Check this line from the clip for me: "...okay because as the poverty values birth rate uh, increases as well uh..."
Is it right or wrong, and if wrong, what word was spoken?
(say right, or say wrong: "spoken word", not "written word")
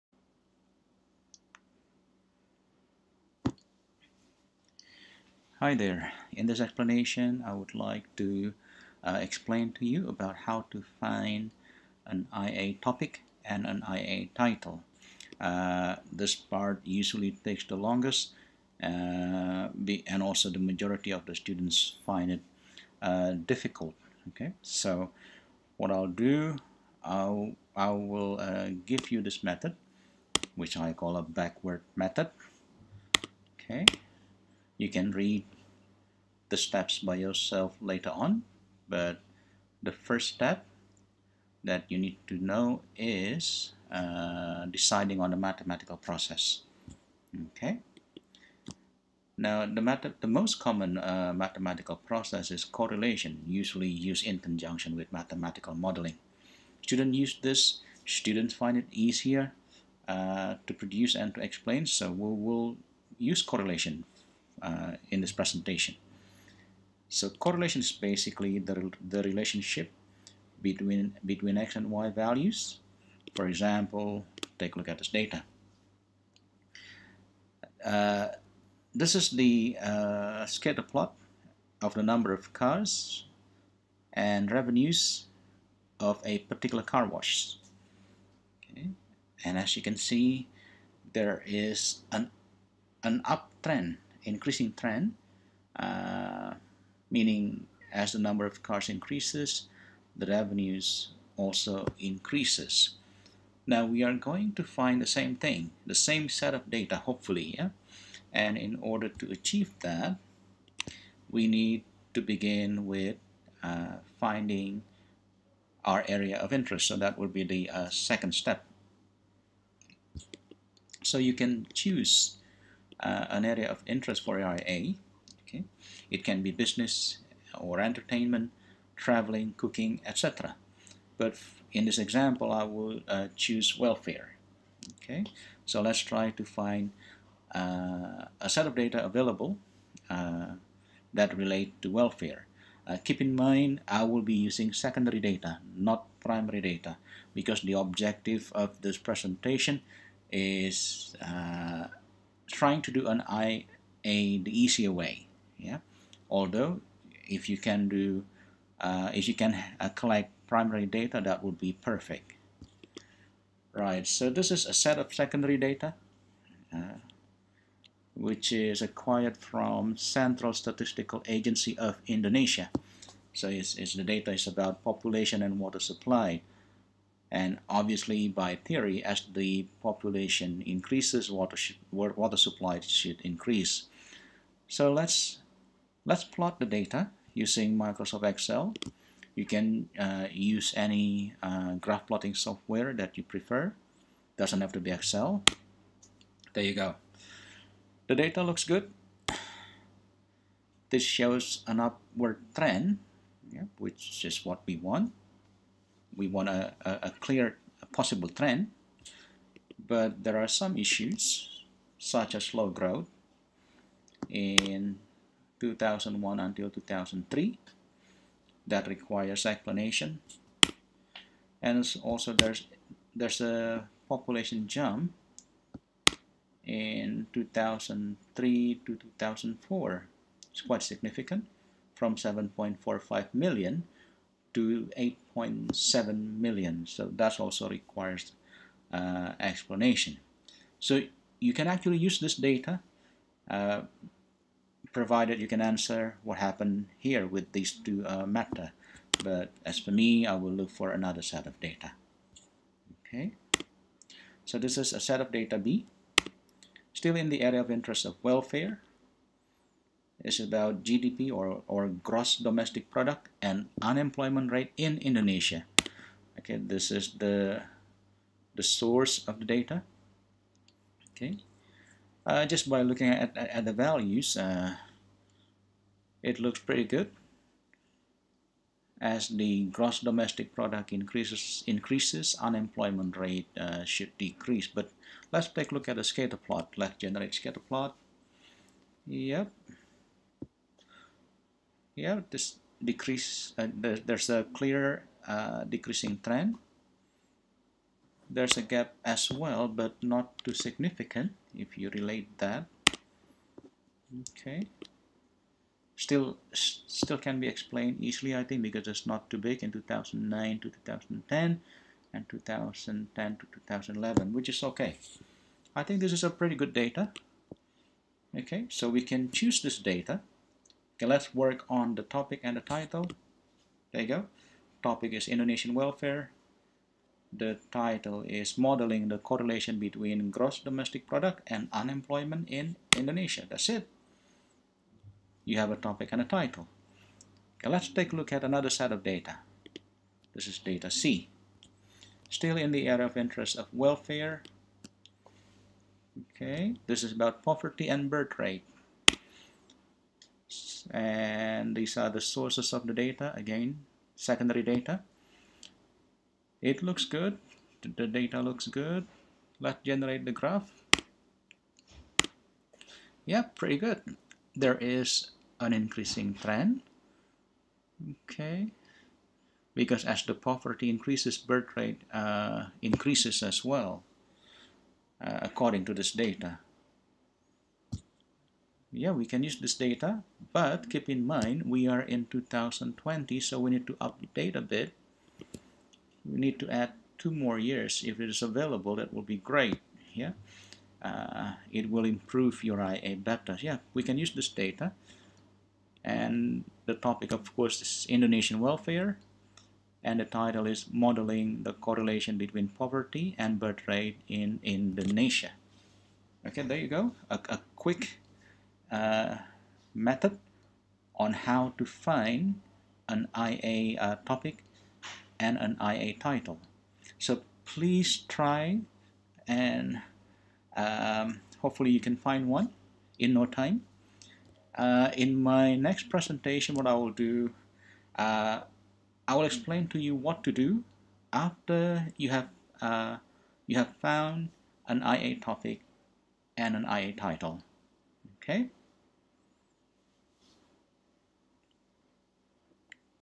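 wrong: "increases", not "values".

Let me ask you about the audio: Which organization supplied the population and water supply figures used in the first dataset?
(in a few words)
Central Statistical Agency of Indonesia.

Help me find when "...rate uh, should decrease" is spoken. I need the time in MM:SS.
04:43.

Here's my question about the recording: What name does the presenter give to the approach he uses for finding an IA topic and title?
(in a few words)
backward method.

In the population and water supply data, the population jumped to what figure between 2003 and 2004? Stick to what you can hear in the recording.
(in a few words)
8.7 million.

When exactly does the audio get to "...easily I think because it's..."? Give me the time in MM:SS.
05:08.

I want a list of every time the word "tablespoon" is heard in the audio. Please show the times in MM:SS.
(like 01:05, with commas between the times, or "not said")
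not said.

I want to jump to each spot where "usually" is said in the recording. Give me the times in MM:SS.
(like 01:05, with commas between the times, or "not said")
00:16, 00:53.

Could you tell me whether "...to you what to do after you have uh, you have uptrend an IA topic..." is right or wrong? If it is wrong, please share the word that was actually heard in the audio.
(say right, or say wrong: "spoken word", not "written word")
wrong: "found", not "uptrend".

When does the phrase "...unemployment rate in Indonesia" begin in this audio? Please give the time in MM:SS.
04:23.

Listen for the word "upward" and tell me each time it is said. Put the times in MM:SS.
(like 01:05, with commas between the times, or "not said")
03:21.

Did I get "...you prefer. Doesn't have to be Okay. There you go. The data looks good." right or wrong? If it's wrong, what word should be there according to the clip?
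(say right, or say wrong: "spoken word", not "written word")
wrong: "Excel", not "Okay".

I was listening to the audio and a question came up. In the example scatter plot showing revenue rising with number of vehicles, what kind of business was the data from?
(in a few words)
car wash.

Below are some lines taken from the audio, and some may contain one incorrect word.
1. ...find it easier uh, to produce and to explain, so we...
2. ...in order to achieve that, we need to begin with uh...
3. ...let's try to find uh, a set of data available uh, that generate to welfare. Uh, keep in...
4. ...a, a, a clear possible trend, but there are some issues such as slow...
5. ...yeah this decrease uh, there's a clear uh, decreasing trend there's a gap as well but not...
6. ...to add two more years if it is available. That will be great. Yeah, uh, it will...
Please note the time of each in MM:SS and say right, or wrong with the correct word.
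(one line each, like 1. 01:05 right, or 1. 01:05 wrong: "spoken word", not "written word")
1. 00:58 right
2. 01:48 right
3. 02:15 wrong: "relate", not "generate"
4. 03:26 right
5. 04:51 right
6. 06:26 right.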